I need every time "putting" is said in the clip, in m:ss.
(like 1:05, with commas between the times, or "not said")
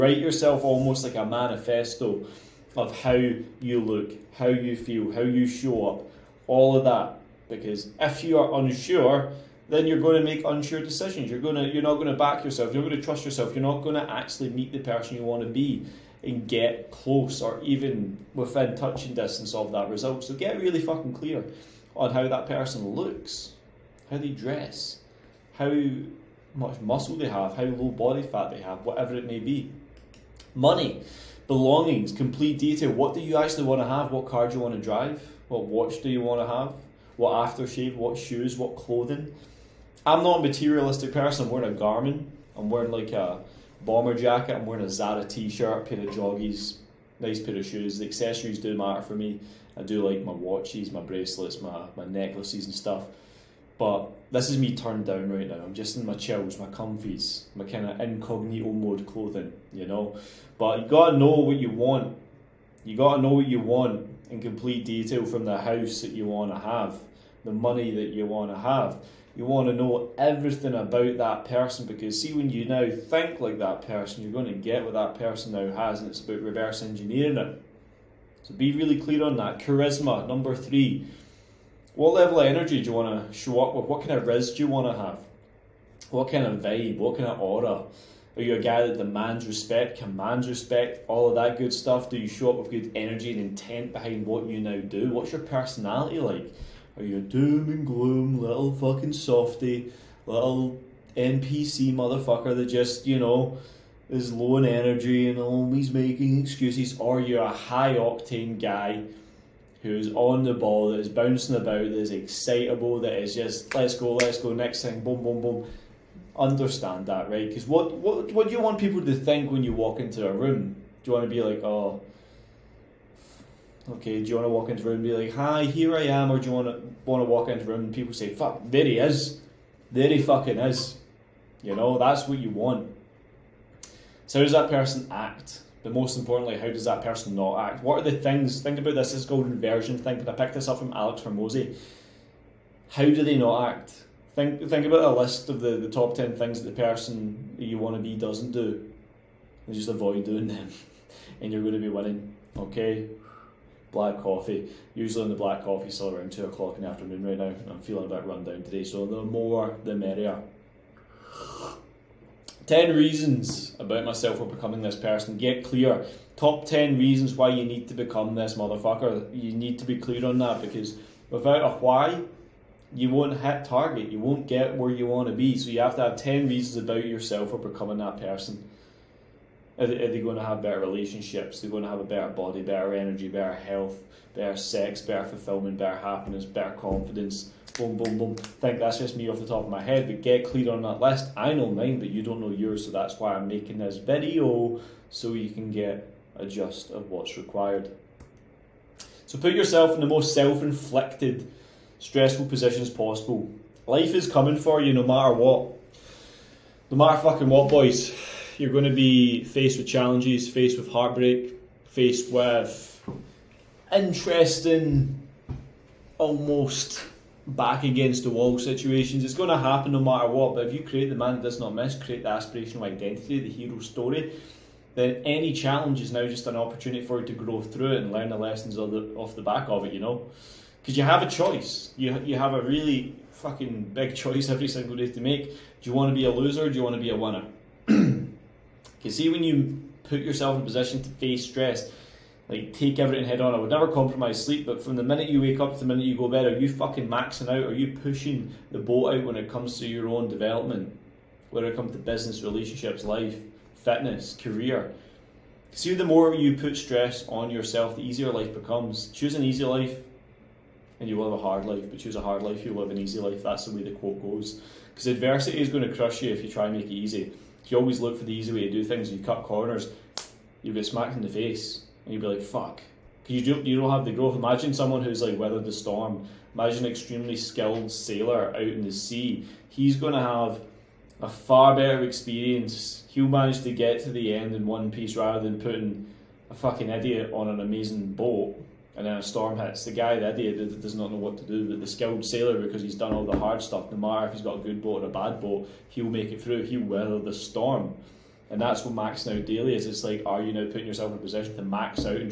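4:45, 5:00.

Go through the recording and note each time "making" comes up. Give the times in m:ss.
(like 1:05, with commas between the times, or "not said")
1:45, 3:13.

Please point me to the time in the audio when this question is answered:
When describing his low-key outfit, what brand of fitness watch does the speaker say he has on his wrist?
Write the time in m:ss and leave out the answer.
0:41.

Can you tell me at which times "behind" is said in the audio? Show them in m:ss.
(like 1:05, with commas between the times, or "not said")
1:33.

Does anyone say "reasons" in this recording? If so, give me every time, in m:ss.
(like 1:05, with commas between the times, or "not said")
2:42, 2:46, 2:56.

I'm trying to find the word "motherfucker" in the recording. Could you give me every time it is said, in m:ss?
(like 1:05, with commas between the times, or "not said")
1:41, 2:48.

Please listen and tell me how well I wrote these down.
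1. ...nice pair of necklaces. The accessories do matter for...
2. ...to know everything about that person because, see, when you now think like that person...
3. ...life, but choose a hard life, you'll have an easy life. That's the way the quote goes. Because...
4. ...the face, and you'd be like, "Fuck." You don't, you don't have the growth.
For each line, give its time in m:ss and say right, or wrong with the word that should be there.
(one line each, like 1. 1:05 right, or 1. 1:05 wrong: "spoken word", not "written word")
1. 0:47 wrong: "shoes", not "necklaces"
2. 1:09 right
3. 4:21 right
4. 4:31 right.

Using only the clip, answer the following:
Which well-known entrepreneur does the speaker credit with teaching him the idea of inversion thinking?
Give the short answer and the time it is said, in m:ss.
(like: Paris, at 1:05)
Alex Hormozi, at 2:20.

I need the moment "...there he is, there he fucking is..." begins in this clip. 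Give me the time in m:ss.
2:08.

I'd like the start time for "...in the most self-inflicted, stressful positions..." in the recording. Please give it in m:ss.
3:19.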